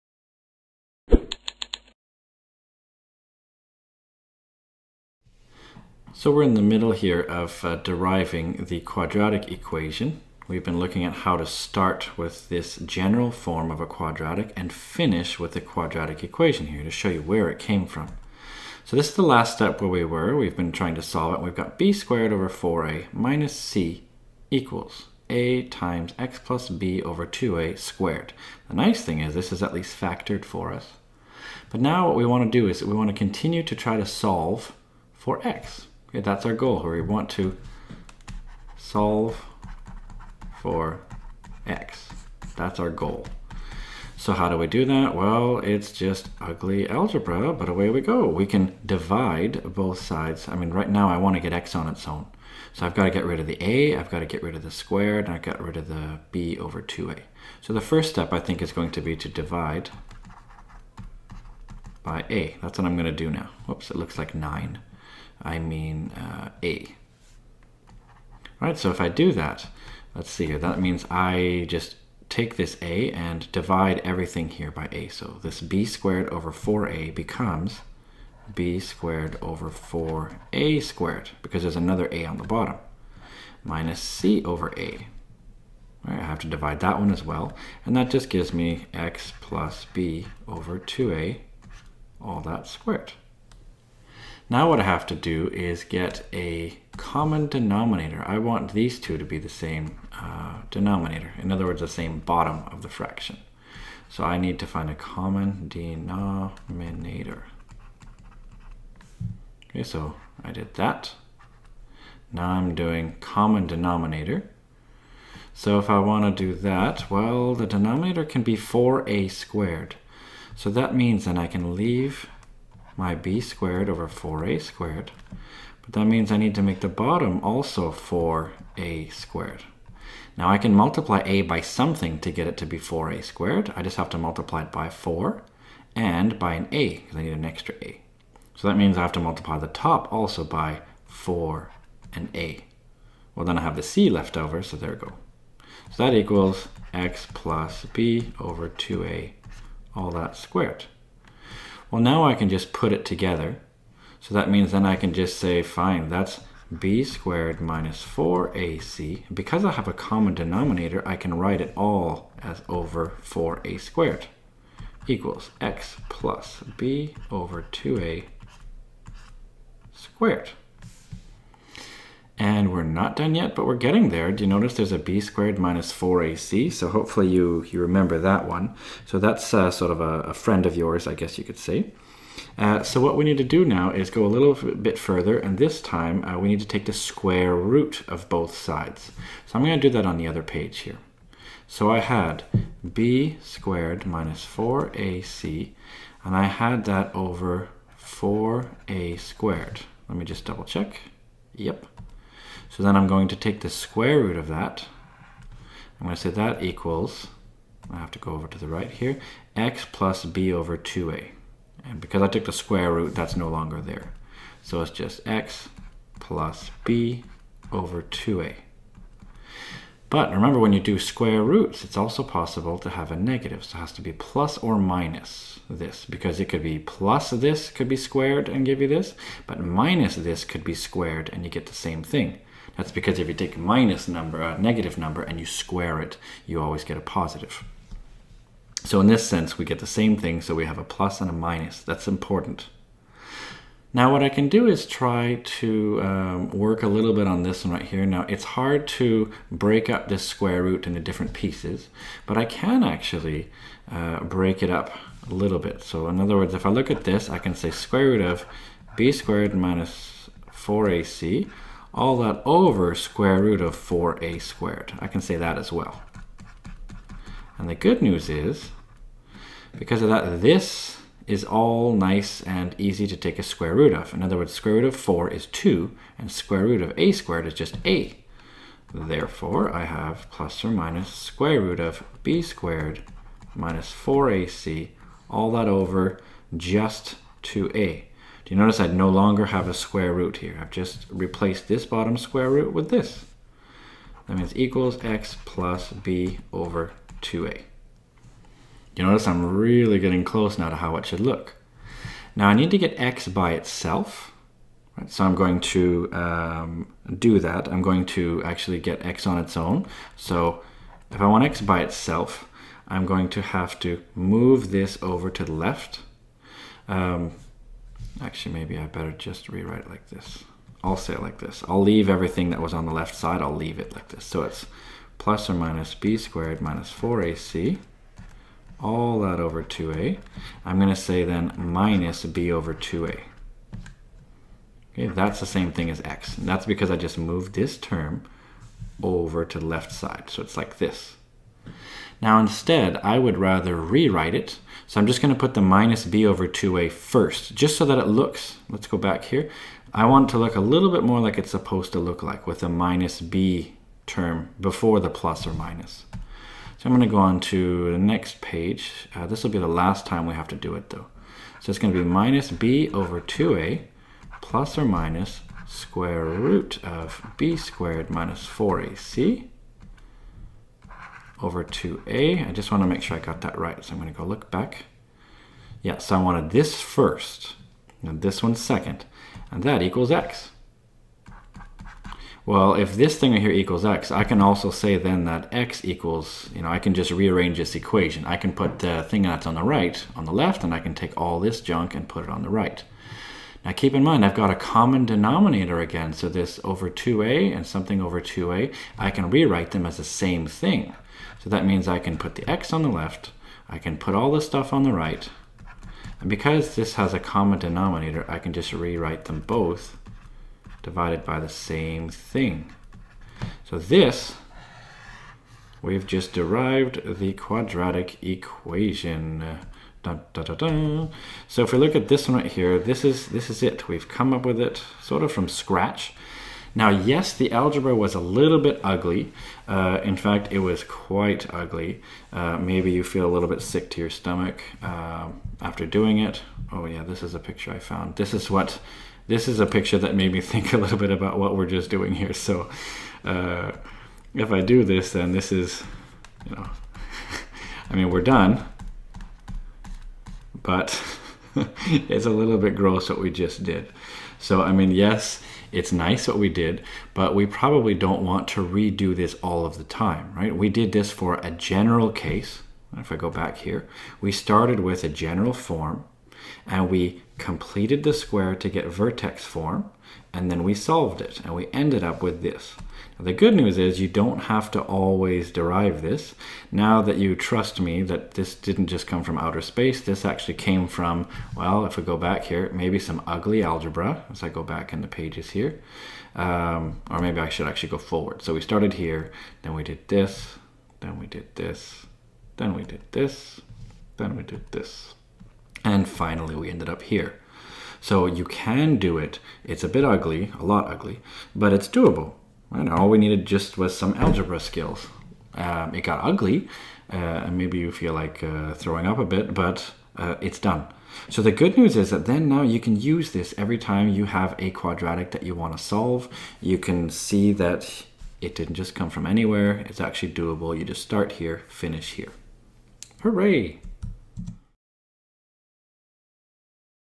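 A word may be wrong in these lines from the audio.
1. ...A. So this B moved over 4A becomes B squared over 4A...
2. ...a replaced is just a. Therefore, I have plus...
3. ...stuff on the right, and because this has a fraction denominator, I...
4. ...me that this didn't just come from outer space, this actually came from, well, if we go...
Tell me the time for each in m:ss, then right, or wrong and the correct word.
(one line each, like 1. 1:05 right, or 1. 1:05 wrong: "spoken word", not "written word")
1. 1:14 wrong: "squared", not "moved"
2. 4:36 wrong: "squared", not "replaced"
3. 6:44 wrong: "common", not "fraction"
4. 7:57 right.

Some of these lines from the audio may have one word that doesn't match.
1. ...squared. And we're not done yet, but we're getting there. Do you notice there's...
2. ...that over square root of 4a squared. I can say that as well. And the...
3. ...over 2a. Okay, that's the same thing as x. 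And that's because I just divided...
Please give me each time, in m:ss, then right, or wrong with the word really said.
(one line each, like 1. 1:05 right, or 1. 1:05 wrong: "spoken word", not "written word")
1. 2:49 right
2. 4:22 right
3. 5:32 wrong: "moved", not "divided".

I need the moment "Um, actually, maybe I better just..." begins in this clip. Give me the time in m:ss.
5:16.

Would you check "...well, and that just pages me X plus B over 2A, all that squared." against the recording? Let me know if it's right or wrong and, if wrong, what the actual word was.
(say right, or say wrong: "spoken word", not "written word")
wrong: "gives", not "pages".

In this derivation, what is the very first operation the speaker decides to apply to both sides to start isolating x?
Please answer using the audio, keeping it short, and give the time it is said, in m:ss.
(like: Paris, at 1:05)
divide by a, at 0:59.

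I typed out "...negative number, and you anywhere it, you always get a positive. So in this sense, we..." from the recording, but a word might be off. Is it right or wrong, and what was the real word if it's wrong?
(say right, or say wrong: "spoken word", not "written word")
wrong: "square", not "anywhere".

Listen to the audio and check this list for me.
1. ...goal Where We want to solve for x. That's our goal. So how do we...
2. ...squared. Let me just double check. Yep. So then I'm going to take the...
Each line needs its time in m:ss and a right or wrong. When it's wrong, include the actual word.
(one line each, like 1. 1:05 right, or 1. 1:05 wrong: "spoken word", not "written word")
1. 0:36 right
2. 3:19 right.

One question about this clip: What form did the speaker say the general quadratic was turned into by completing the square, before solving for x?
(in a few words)
vertex form.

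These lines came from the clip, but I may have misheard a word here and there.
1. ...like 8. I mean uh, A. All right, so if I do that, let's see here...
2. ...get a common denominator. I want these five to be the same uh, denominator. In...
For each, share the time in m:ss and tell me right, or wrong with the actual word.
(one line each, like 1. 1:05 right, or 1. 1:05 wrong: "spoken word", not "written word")
1. 1:04 wrong: "9", not "8"
2. 1:35 wrong: "two", not "five".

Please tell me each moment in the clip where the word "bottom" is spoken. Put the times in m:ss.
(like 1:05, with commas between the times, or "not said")
1:22, 1:42, 2:06, 4:51.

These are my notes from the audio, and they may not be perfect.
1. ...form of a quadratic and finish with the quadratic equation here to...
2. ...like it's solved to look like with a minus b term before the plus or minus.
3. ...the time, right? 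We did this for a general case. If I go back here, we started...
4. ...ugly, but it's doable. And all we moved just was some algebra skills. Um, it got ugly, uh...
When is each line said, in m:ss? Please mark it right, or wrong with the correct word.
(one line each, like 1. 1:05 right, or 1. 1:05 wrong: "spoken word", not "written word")
1. 0:13 right
2. 5:51 wrong: "supposed", not "solved"
3. 7:39 right
4. 8:20 wrong: "needed", not "moved".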